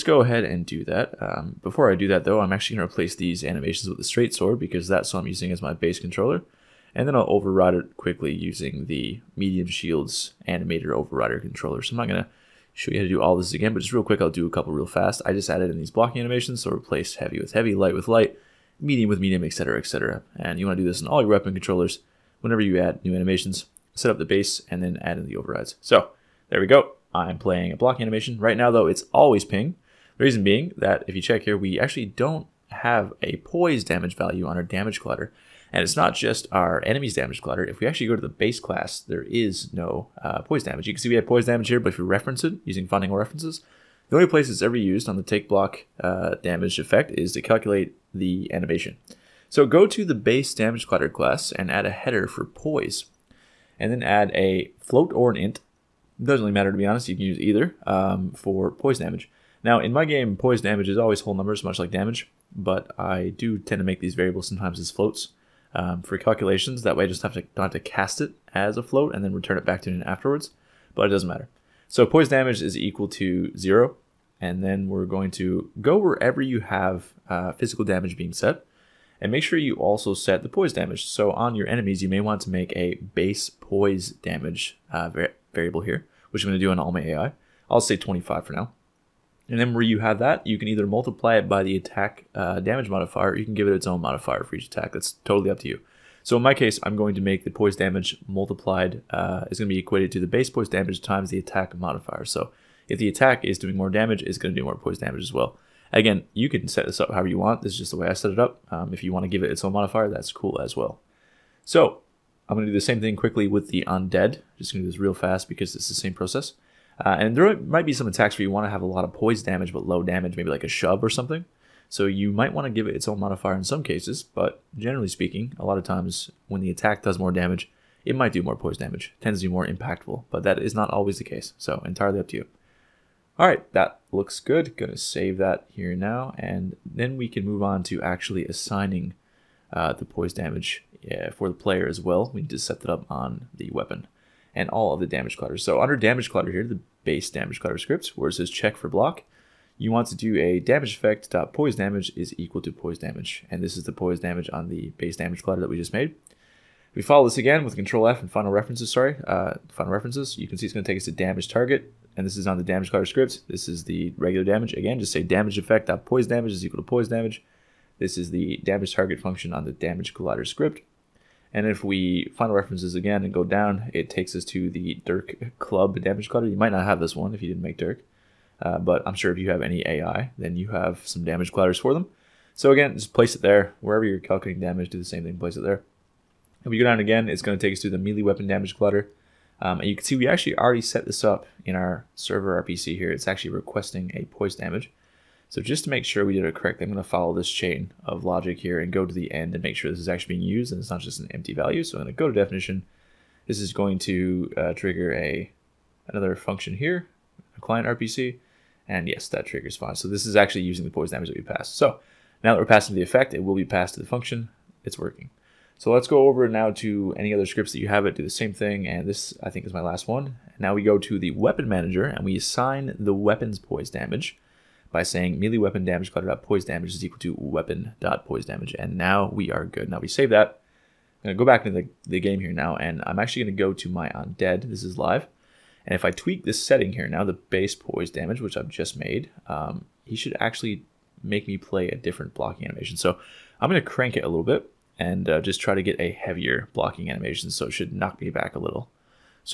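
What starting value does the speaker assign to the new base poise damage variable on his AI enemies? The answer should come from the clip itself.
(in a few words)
25.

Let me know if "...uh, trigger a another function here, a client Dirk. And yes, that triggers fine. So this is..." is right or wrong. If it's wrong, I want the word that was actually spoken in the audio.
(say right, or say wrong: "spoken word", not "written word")
wrong: "RPC", not "Dirk".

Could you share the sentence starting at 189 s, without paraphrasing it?
Um, and you can see we actually already set this up in our server RPC here.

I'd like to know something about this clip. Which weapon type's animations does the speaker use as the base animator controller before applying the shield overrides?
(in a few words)
straight sword.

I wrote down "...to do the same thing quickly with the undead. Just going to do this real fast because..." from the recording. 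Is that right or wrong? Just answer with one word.
right.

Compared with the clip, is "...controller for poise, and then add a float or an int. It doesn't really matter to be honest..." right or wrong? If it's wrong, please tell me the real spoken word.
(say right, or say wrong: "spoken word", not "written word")
wrong: "header", not "controller".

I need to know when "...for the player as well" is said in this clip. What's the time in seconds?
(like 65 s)
141 s.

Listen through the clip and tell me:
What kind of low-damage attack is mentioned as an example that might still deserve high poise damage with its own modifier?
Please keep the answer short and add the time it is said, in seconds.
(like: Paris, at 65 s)
a shove, at 120 s.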